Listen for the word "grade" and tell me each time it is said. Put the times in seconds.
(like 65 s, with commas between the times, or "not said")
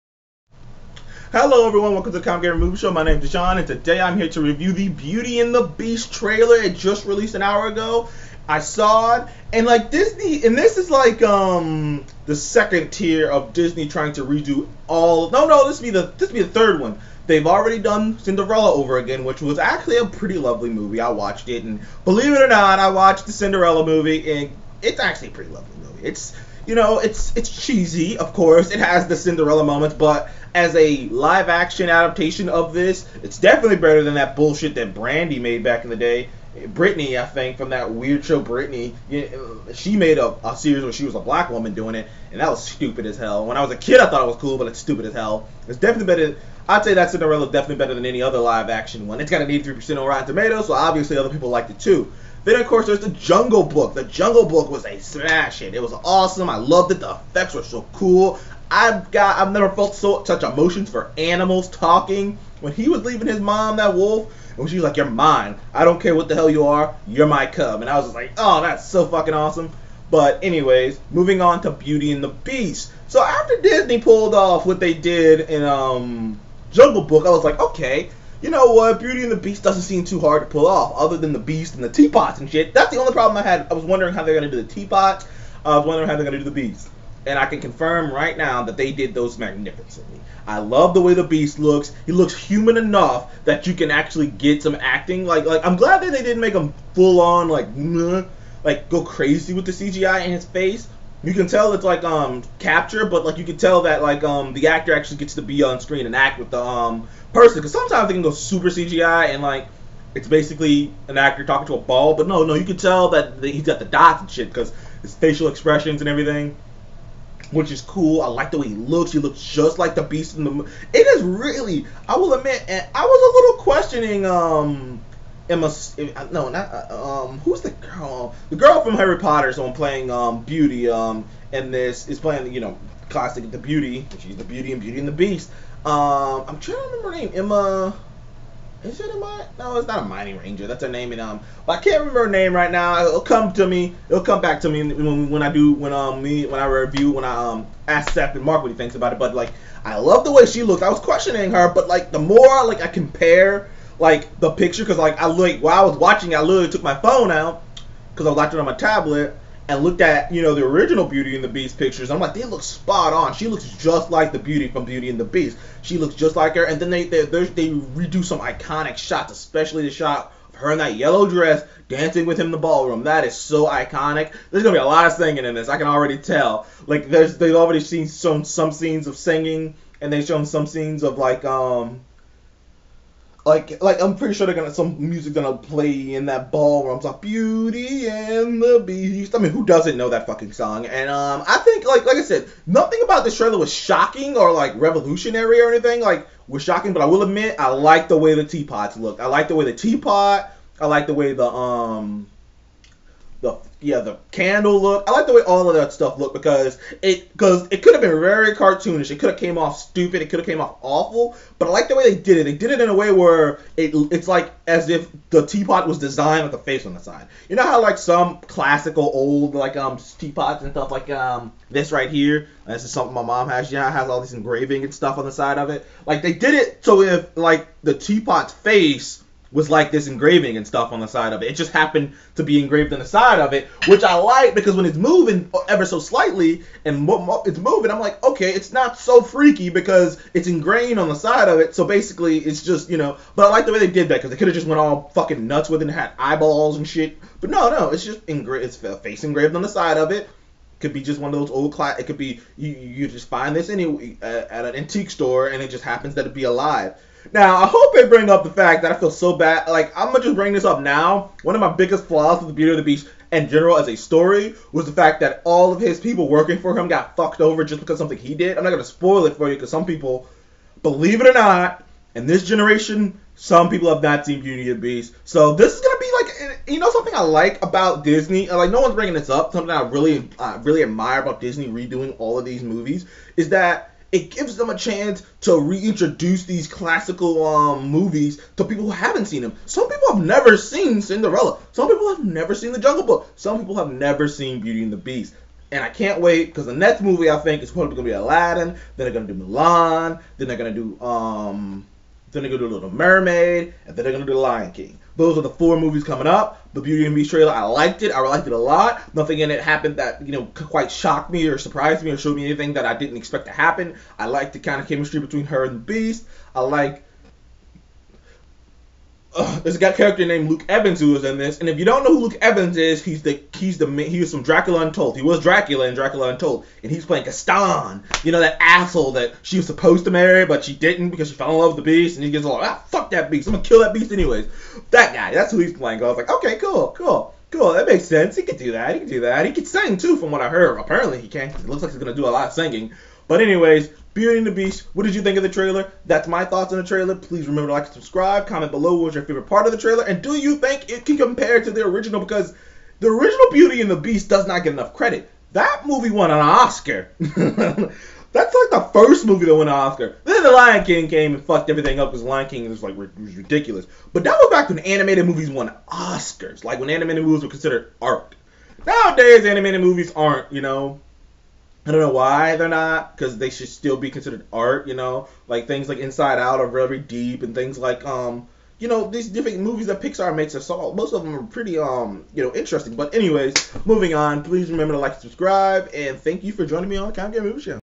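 not said.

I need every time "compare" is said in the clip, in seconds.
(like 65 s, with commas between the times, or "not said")
152 s, 351 s.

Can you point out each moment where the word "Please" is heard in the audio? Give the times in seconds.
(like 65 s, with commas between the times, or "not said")
347 s, 384 s.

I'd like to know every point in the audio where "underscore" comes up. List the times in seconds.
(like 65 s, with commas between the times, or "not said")
not said.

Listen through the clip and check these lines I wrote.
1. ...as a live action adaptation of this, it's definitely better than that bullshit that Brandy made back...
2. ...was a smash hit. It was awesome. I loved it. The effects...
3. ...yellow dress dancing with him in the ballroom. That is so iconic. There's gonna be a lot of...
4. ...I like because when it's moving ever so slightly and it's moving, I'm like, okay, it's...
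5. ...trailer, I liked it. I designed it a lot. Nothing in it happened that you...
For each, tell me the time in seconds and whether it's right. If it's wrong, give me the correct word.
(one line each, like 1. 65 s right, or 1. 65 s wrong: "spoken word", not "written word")
1. 30 s right
2. 54 s right
3. 170 s right
4. 234 s right
5. 307 s wrong: "liked", not "designed".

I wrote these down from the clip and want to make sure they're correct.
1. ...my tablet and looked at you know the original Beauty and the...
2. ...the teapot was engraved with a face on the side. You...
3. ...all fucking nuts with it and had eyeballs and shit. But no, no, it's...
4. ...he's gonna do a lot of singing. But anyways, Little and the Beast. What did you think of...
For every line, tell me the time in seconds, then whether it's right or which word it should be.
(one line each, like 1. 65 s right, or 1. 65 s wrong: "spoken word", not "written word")
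1. 158 s right
2. 215 s wrong: "designed", not "engraved"
3. 244 s right
4. 341 s wrong: "Beauty", not "Little".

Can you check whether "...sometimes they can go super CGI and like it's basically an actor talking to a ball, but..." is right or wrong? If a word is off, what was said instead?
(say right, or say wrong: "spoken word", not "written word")
right.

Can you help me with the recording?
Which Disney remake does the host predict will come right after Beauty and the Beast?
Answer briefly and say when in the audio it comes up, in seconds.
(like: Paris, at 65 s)
Aladdin, at 298 s.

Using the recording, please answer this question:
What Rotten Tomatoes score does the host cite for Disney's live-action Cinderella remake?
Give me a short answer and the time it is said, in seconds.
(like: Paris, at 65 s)
83%, at 49 s.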